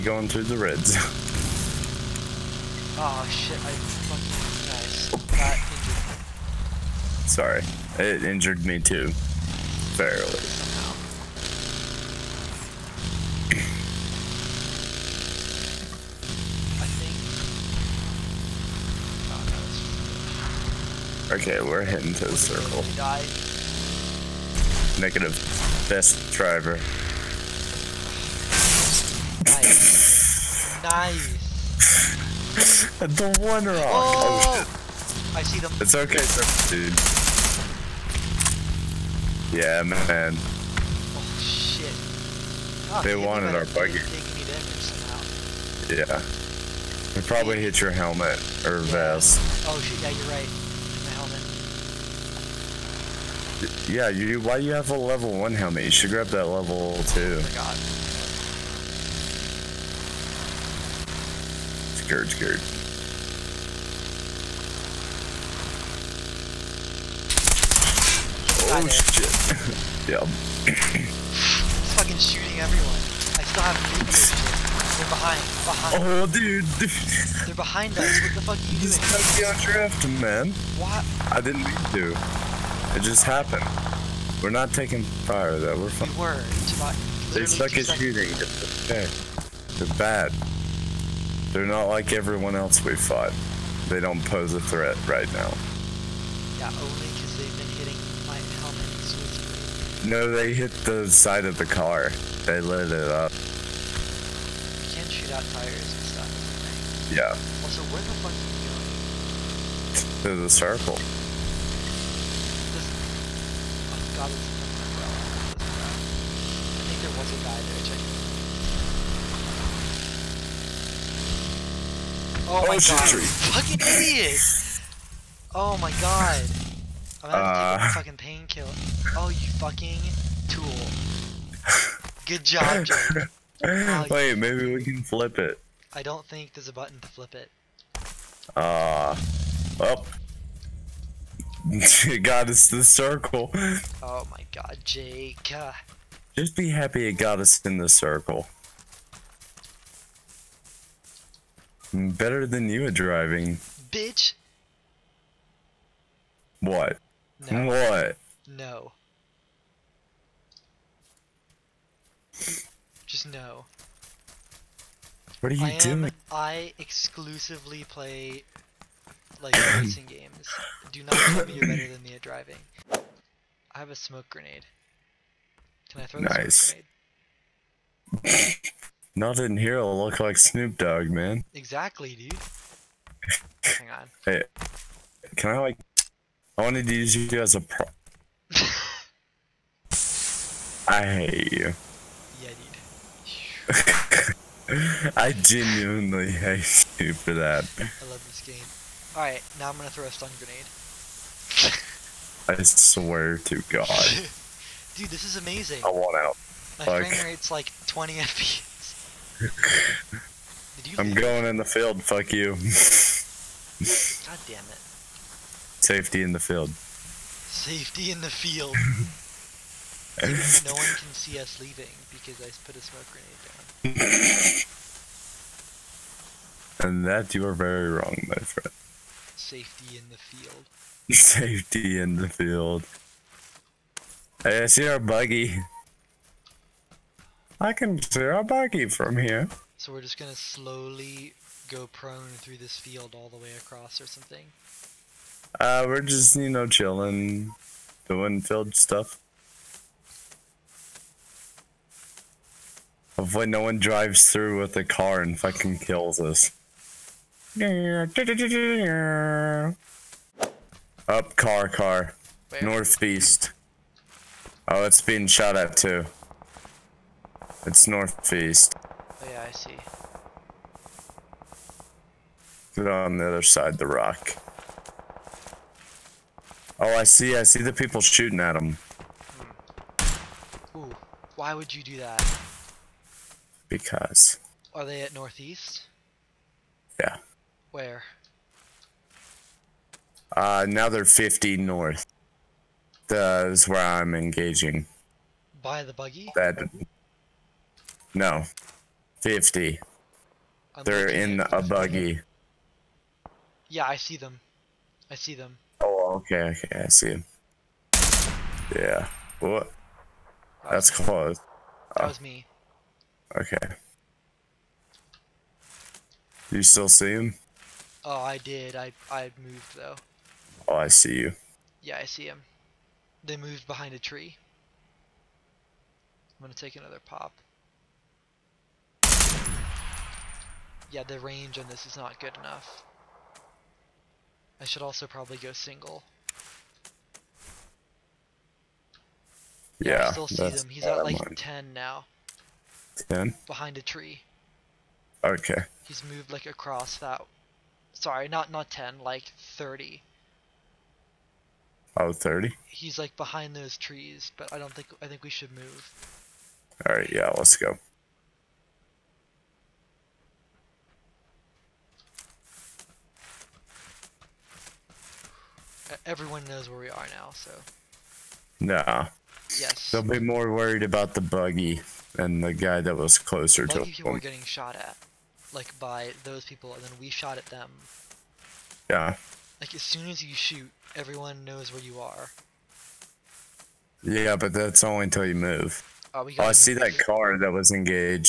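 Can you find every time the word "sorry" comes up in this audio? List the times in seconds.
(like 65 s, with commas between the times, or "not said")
7 s, 347 s.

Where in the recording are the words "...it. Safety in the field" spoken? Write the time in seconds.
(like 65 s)
214 s.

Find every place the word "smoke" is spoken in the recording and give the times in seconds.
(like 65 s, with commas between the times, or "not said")
173 s, 222 s.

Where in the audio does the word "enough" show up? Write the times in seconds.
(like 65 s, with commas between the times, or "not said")
332 s.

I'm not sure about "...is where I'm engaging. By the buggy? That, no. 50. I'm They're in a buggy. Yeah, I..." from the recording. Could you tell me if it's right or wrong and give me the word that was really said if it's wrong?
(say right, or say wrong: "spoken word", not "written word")
right.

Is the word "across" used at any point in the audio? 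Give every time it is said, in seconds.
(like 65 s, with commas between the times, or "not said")
243 s, 346 s.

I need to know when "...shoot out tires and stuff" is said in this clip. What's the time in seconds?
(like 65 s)
105 s.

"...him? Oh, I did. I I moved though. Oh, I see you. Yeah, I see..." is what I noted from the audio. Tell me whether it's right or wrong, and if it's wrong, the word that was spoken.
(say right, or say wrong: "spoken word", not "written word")
right.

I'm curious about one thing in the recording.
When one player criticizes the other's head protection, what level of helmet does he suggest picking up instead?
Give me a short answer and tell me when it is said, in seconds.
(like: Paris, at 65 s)
Level two, at 56 s.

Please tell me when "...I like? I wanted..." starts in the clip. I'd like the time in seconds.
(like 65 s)
185 s.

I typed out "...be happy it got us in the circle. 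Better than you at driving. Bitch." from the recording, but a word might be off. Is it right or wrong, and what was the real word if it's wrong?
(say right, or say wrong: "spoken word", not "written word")
right.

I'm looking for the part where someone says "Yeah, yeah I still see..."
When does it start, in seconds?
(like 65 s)
339 s.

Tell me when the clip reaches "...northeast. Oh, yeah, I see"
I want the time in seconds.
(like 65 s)
267 s.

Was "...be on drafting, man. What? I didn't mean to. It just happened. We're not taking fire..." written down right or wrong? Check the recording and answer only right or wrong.
right.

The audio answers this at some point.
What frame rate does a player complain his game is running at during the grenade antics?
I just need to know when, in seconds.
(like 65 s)
207 s.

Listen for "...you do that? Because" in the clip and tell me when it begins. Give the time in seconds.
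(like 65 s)
281 s.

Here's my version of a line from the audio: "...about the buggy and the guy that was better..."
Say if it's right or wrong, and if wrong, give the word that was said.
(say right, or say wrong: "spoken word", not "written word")
wrong: "closer", not "better".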